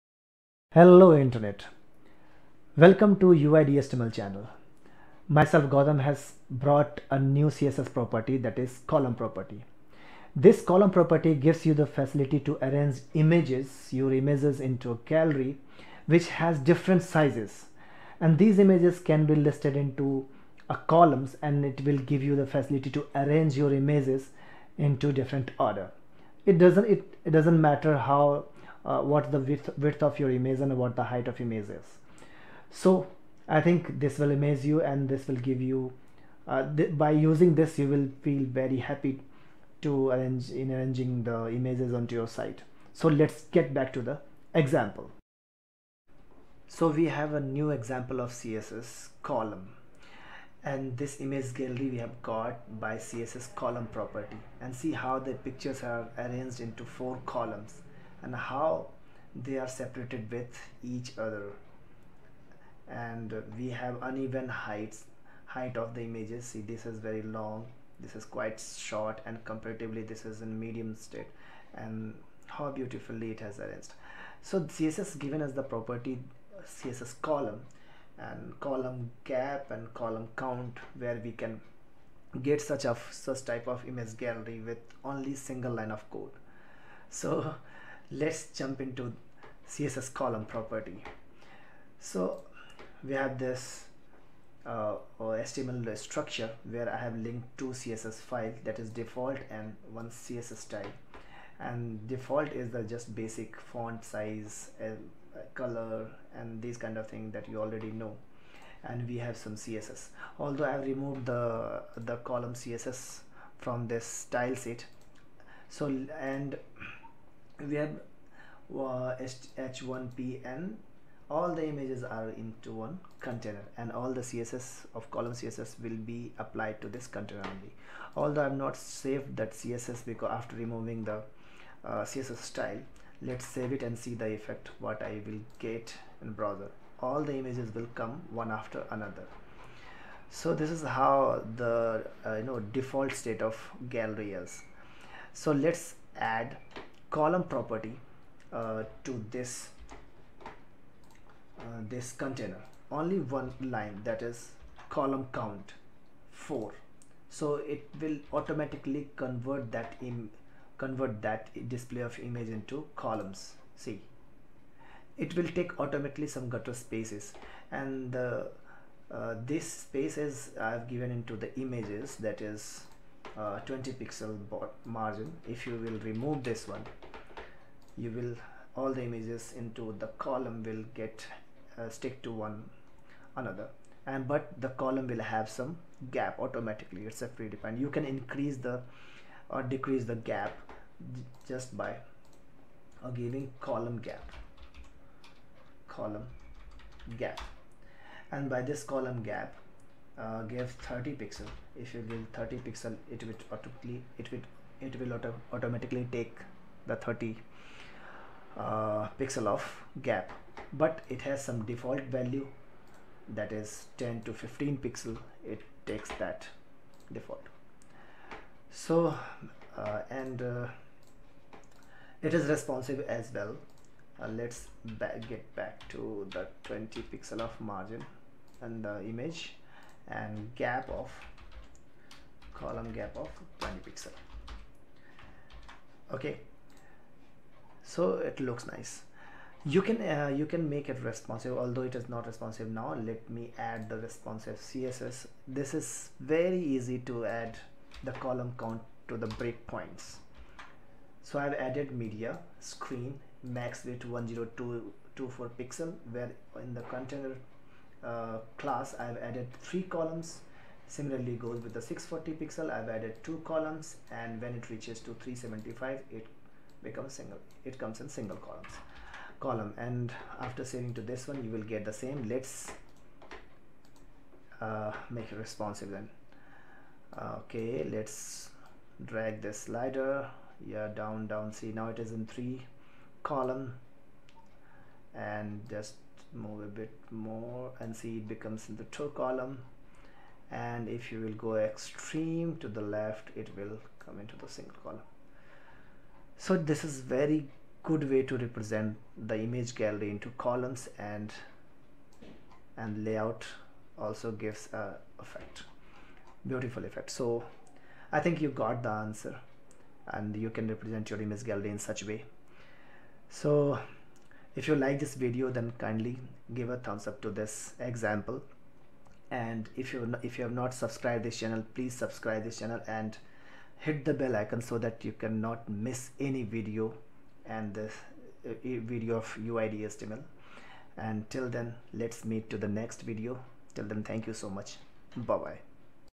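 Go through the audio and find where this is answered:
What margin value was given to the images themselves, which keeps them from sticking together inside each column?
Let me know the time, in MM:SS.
02:53.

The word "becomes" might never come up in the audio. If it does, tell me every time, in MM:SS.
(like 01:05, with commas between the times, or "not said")
04:26, 04:48.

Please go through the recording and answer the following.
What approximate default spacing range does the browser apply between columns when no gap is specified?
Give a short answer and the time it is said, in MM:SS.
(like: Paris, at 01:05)
10 to 15 pixels, at 03:33.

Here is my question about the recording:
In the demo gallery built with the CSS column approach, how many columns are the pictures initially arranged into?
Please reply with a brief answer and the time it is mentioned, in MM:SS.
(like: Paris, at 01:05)
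4, at 00:56.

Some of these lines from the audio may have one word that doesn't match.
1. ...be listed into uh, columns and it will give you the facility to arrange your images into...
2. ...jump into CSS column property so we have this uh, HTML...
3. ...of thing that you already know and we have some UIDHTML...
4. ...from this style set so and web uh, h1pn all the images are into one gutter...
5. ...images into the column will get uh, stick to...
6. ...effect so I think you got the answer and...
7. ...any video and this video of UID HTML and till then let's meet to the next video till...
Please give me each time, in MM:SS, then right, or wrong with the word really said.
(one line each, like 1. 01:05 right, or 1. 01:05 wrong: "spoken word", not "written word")
1. 00:19 right
2. 01:28 right
3. 01:46 wrong: "CSS", not "UIDHTML"
4. 01:53 wrong: "container", not "gutter"
5. 02:59 right
6. 05:06 right
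7. 05:26 right.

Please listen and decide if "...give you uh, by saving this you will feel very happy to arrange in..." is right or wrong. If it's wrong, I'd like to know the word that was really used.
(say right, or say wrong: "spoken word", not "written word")
wrong: "using", not "saving".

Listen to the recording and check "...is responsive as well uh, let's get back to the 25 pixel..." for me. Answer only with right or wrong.
wrong.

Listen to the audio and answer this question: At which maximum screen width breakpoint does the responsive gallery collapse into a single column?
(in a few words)
375.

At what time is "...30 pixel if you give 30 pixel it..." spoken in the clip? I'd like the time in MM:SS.
03:20.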